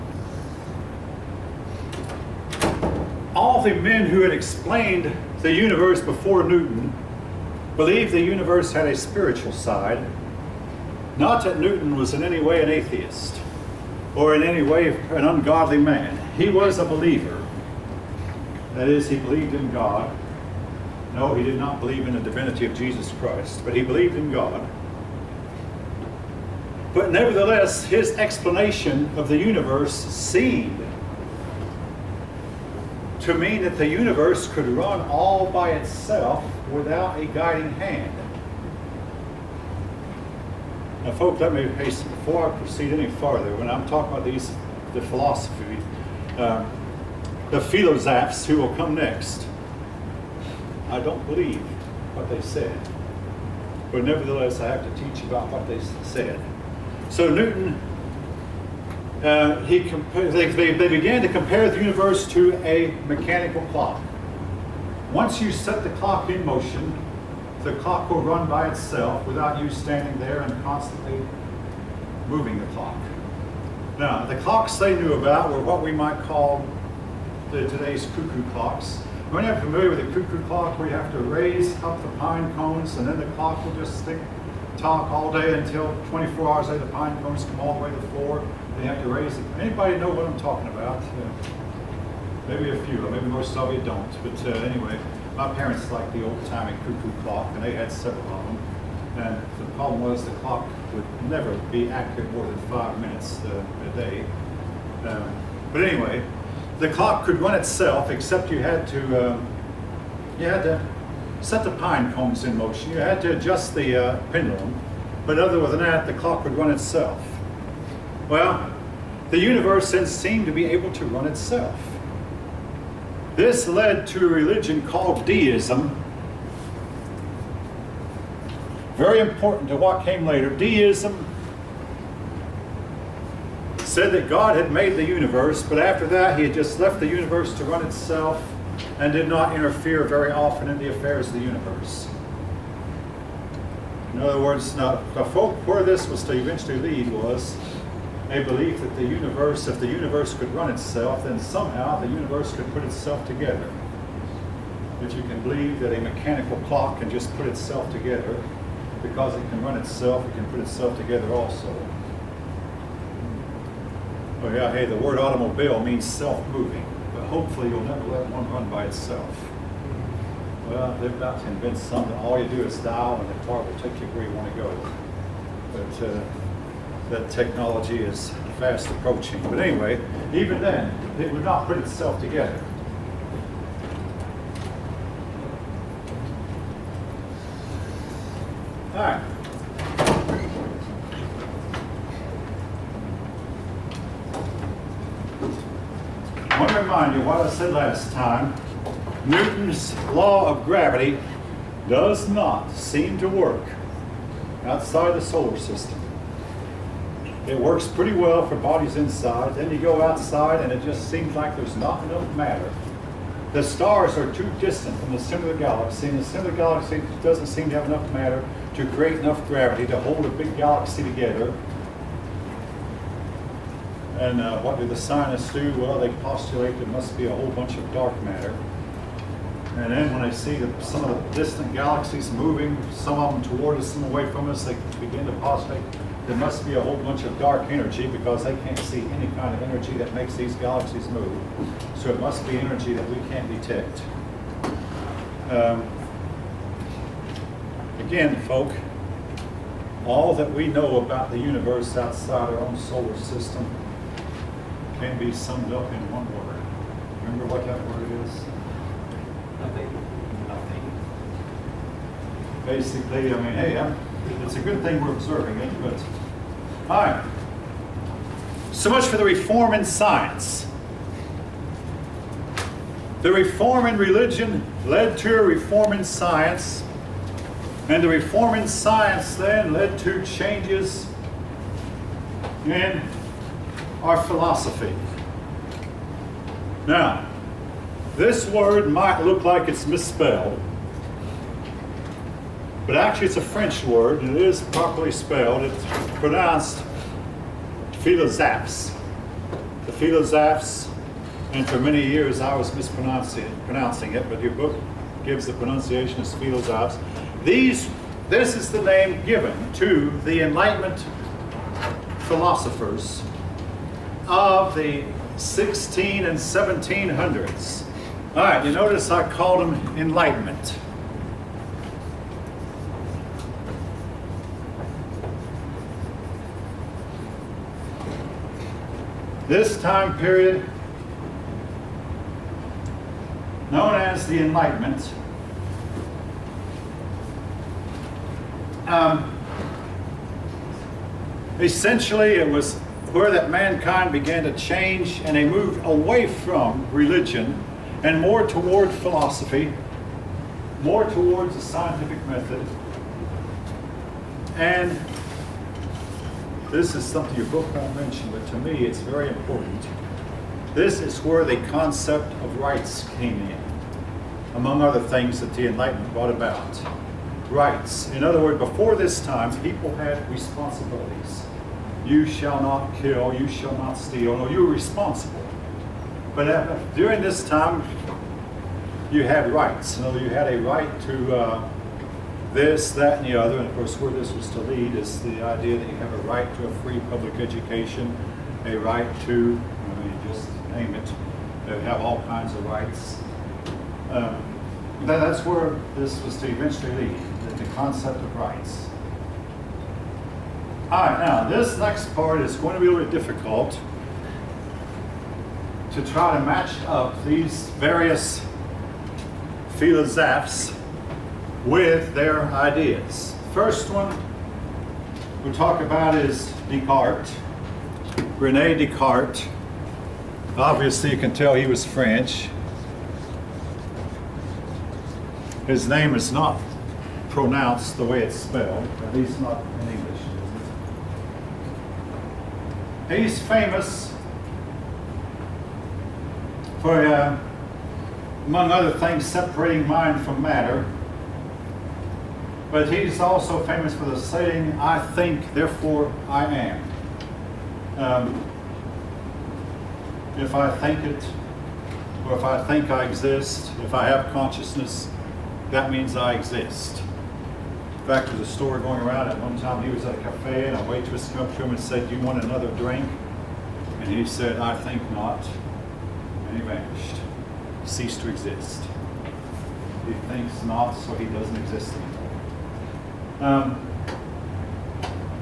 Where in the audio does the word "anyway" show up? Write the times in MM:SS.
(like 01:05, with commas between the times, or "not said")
01:34, 01:45, 02:59.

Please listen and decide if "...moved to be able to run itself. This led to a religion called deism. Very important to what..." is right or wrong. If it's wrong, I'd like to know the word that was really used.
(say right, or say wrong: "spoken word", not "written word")
wrong: "seemed", not "moved".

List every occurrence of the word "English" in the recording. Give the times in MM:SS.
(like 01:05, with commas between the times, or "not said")
07:09.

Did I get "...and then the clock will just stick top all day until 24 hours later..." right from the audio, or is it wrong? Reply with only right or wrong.
right.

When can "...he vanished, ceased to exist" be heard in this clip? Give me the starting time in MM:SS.
07:46.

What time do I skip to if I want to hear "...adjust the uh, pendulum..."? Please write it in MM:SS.
01:53.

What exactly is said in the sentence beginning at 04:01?
So it must be energy that we can't detect.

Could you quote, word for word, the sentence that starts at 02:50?
Well, they're about to invent something.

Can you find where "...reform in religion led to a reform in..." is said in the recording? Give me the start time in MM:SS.
04:33.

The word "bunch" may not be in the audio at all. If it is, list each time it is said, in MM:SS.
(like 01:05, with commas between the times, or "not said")
03:47, 03:56.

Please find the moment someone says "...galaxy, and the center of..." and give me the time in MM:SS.
03:35.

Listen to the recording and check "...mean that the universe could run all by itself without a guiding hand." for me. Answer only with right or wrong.
right.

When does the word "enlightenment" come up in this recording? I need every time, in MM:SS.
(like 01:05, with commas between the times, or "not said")
05:10, 05:19, 05:34, 06:05.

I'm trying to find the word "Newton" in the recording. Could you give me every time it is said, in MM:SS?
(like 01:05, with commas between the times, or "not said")
00:06, 00:11, 00:57, 03:19.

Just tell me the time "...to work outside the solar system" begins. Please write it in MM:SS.
03:23.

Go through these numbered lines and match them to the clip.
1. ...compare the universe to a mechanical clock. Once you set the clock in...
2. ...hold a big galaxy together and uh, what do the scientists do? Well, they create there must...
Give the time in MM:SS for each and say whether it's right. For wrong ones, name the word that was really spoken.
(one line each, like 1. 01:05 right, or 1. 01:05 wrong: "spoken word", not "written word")
1. 01:01 right
2. 03:40 wrong: "postulate", not "create".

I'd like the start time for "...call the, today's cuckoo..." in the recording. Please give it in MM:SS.
01:16.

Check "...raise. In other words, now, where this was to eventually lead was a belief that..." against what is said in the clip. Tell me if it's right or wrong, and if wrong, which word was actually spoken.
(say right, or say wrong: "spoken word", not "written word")
wrong: "universe", not "raise".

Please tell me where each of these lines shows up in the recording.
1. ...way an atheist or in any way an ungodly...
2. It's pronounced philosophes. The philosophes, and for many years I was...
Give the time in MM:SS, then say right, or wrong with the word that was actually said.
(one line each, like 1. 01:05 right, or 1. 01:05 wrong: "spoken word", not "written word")
1. 00:12 right
2. 04:55 right.